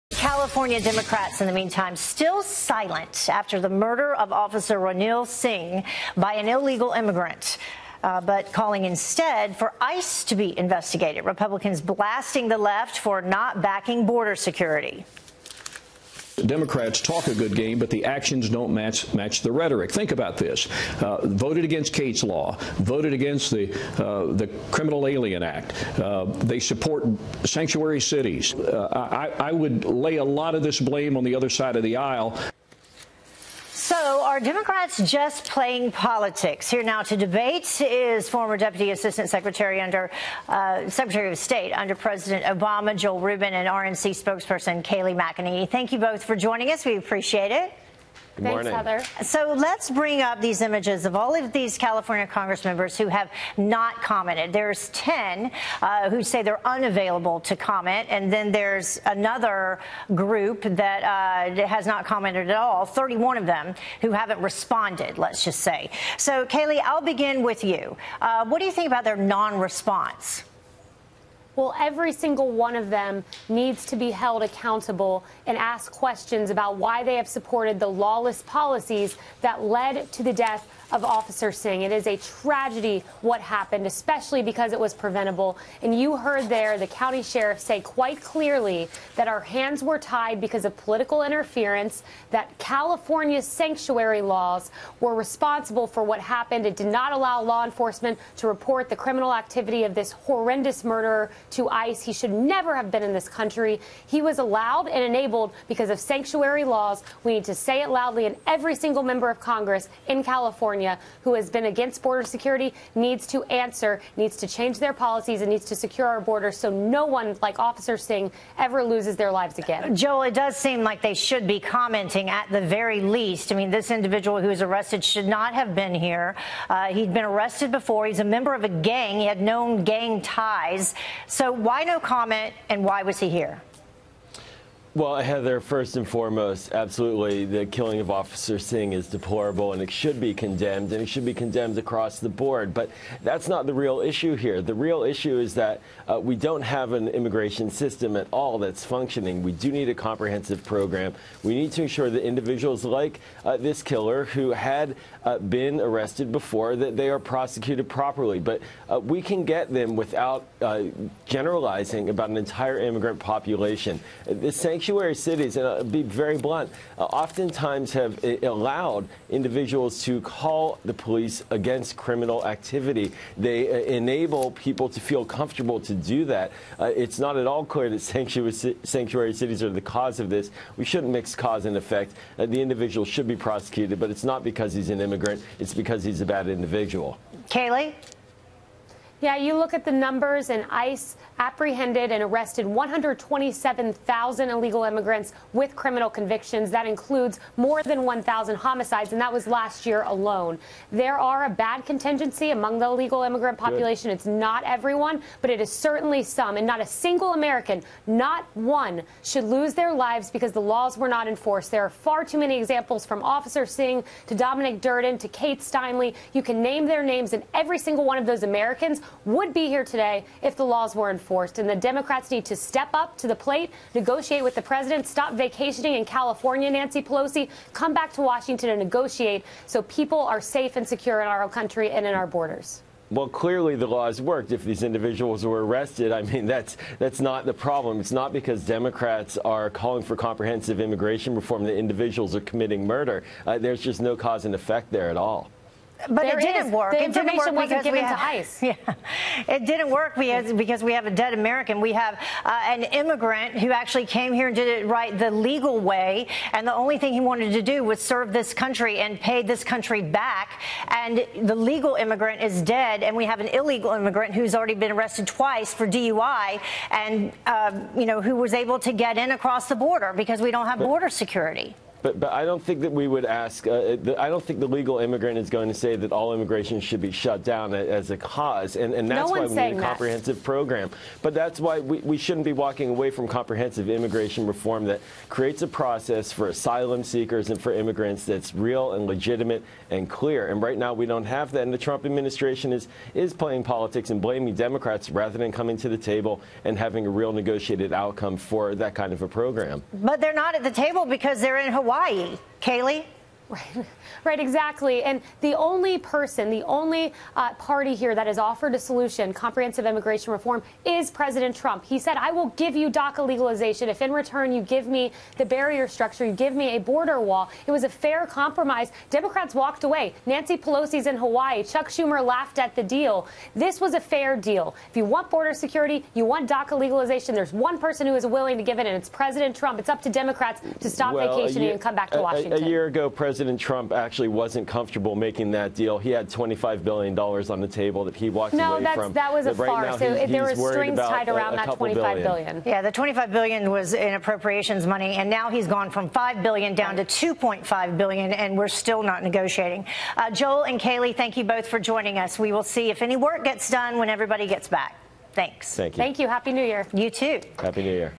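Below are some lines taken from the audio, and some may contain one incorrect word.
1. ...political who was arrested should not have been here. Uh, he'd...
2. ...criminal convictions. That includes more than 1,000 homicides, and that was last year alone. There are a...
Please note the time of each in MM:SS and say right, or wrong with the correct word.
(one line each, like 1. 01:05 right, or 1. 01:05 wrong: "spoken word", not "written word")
1. 02:03 wrong: "individual", not "political"
2. 03:15 right.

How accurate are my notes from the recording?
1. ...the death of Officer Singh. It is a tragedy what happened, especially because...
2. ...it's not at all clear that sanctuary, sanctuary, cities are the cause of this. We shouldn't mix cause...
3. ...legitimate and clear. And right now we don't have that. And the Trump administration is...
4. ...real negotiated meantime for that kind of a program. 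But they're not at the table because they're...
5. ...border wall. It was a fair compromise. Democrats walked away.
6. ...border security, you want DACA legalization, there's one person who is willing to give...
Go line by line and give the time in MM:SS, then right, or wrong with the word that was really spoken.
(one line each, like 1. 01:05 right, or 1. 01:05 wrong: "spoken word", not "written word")
1. 01:20 right
2. 02:56 right
3. 04:49 right
4. 04:57 wrong: "outcome", not "meantime"
5. 05:16 right
6. 05:25 right.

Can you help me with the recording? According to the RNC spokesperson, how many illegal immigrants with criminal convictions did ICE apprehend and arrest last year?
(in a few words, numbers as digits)
127,000.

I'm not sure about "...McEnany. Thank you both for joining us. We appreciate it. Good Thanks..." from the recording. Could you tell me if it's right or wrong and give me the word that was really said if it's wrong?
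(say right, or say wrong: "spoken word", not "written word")
right.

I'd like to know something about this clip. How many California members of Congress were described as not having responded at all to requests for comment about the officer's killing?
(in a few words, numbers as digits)
31.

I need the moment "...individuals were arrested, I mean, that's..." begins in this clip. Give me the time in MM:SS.
03:54.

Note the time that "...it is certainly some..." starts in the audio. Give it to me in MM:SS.
03:25.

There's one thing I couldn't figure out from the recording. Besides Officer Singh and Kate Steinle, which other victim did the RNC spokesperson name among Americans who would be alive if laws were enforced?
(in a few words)
Dominic Durden.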